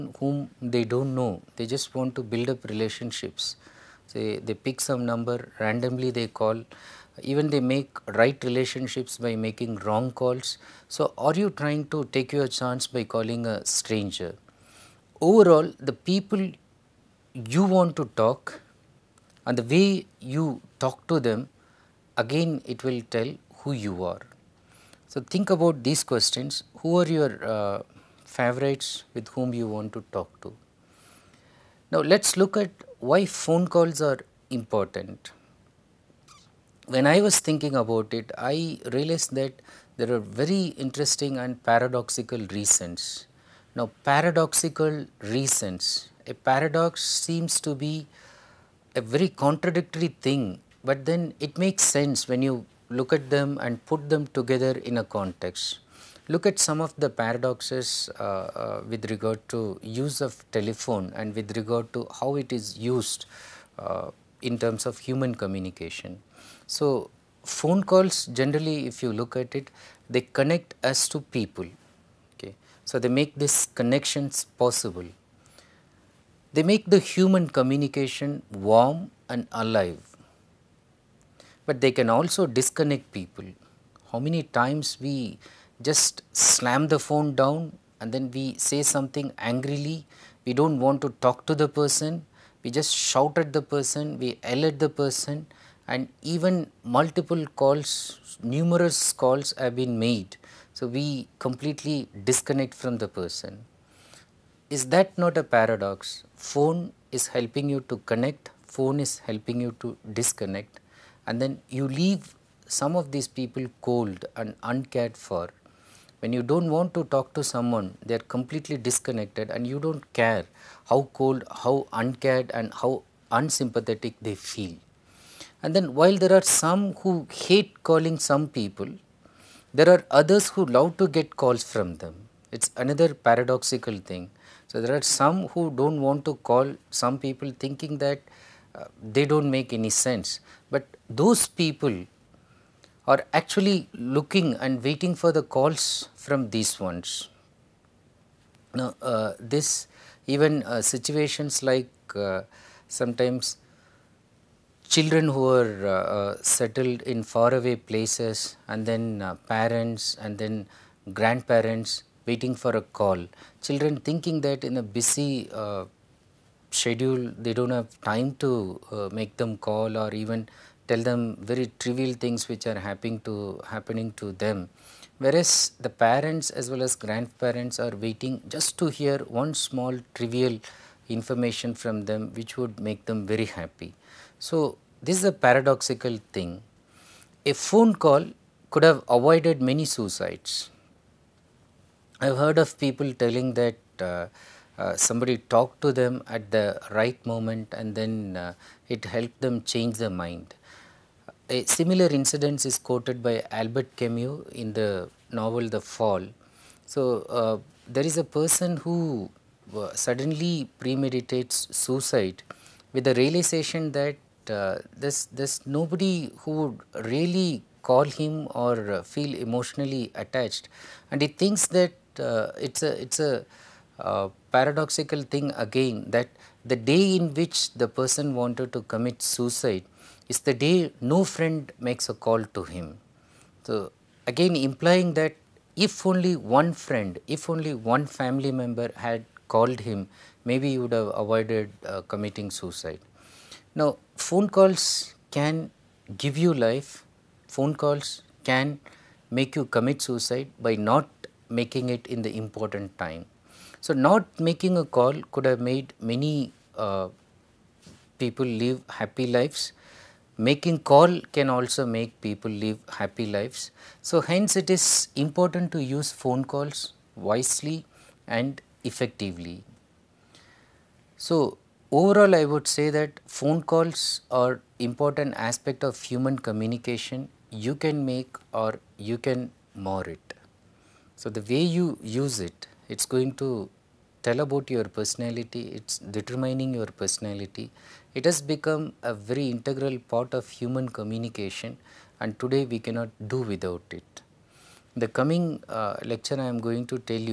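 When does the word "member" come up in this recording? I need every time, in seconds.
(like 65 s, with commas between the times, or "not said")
238 s.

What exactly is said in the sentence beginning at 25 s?
So, think about these questions who are your uh, favorites with whom you want to talk to?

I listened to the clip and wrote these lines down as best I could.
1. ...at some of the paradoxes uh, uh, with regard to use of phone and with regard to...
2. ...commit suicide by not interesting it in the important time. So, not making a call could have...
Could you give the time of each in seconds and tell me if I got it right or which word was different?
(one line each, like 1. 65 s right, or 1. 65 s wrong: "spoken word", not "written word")
1. 56 s wrong: "telephone", not "phone"
2. 249 s wrong: "making", not "interesting".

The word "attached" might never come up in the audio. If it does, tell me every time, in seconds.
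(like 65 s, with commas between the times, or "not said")
220 s.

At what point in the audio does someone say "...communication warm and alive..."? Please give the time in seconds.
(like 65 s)
77 s.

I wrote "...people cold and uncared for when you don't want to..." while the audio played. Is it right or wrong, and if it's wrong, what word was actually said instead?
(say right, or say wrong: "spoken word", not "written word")
right.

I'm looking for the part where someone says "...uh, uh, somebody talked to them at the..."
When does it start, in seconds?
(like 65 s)
194 s.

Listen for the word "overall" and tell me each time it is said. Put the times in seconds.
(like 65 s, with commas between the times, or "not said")
15 s, 271 s.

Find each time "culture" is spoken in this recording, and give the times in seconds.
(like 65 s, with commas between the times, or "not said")
not said.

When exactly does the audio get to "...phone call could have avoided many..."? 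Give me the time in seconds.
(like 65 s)
187 s.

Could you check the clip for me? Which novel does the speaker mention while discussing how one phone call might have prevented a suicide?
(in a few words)
The Fall.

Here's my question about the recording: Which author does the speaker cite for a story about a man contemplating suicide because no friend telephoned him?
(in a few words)
Albert Camus.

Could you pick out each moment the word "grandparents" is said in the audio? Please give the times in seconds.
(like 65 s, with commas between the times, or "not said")
161 s, 176 s.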